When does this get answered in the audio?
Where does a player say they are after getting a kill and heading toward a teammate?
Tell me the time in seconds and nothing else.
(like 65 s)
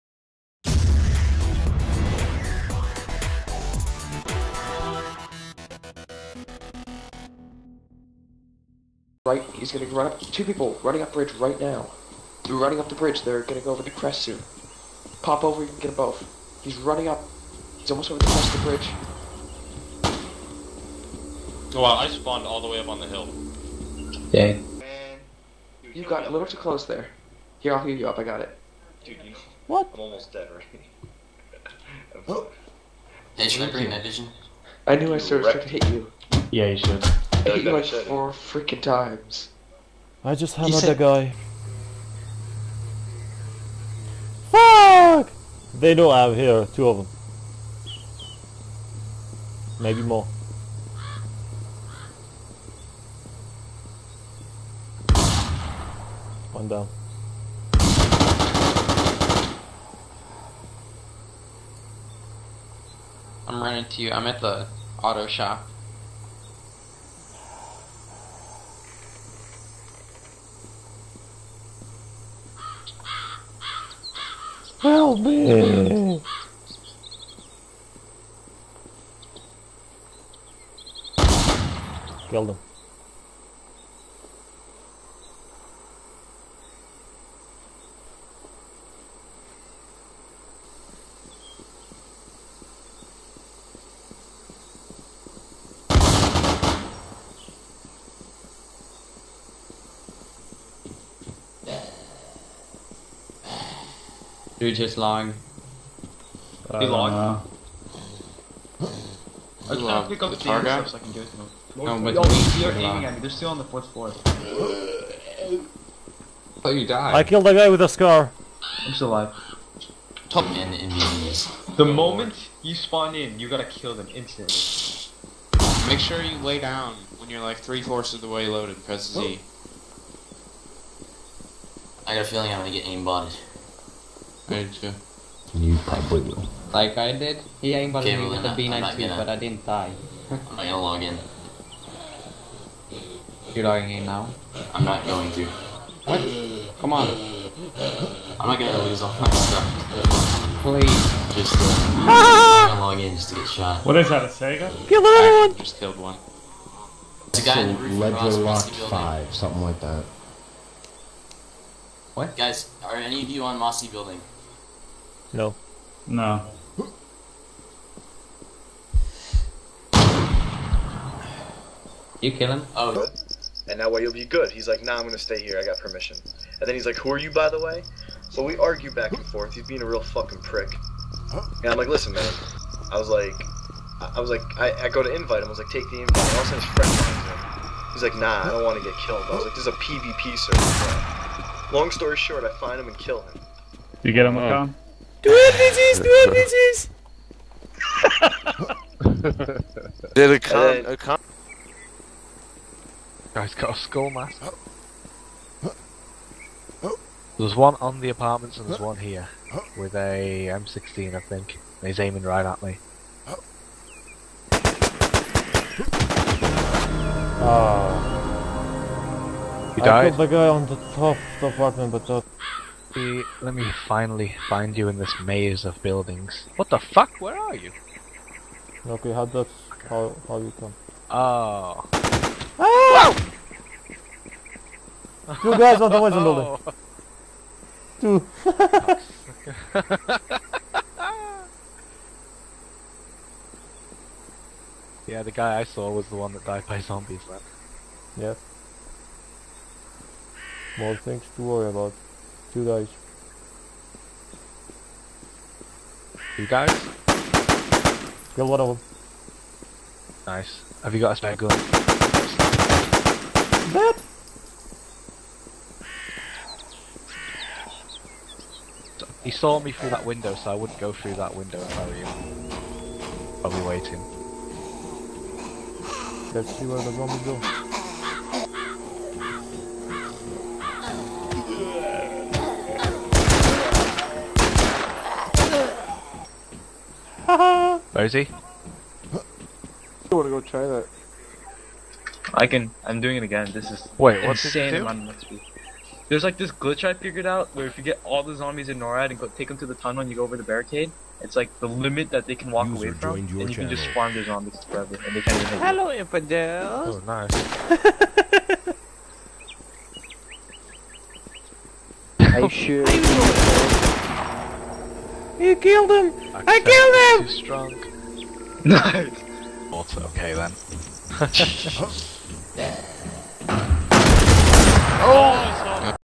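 65 s.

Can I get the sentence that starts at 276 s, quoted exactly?
Let's see where the bomb is go.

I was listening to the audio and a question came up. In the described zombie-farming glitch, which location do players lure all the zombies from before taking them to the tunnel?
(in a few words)
NORAD.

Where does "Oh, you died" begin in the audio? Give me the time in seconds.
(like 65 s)
116 s.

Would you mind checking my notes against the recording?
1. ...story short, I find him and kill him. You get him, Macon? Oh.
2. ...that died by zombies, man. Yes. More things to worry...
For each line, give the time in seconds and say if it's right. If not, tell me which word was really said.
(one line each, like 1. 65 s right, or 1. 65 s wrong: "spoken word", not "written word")
1. 191 s right
2. 246 s right.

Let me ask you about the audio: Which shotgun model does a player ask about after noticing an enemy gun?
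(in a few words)
Saiga.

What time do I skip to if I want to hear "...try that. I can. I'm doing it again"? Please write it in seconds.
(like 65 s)
290 s.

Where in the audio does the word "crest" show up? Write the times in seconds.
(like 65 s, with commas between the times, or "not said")
13 s, 18 s.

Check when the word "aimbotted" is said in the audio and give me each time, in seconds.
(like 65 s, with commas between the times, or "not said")
132 s, 137 s.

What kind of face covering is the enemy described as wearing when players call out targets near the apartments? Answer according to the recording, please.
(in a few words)
skull mask.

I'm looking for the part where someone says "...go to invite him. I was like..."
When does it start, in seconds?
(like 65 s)
184 s.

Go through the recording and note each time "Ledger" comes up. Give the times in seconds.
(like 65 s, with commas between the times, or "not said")
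157 s.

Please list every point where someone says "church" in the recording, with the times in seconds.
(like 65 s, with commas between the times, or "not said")
not said.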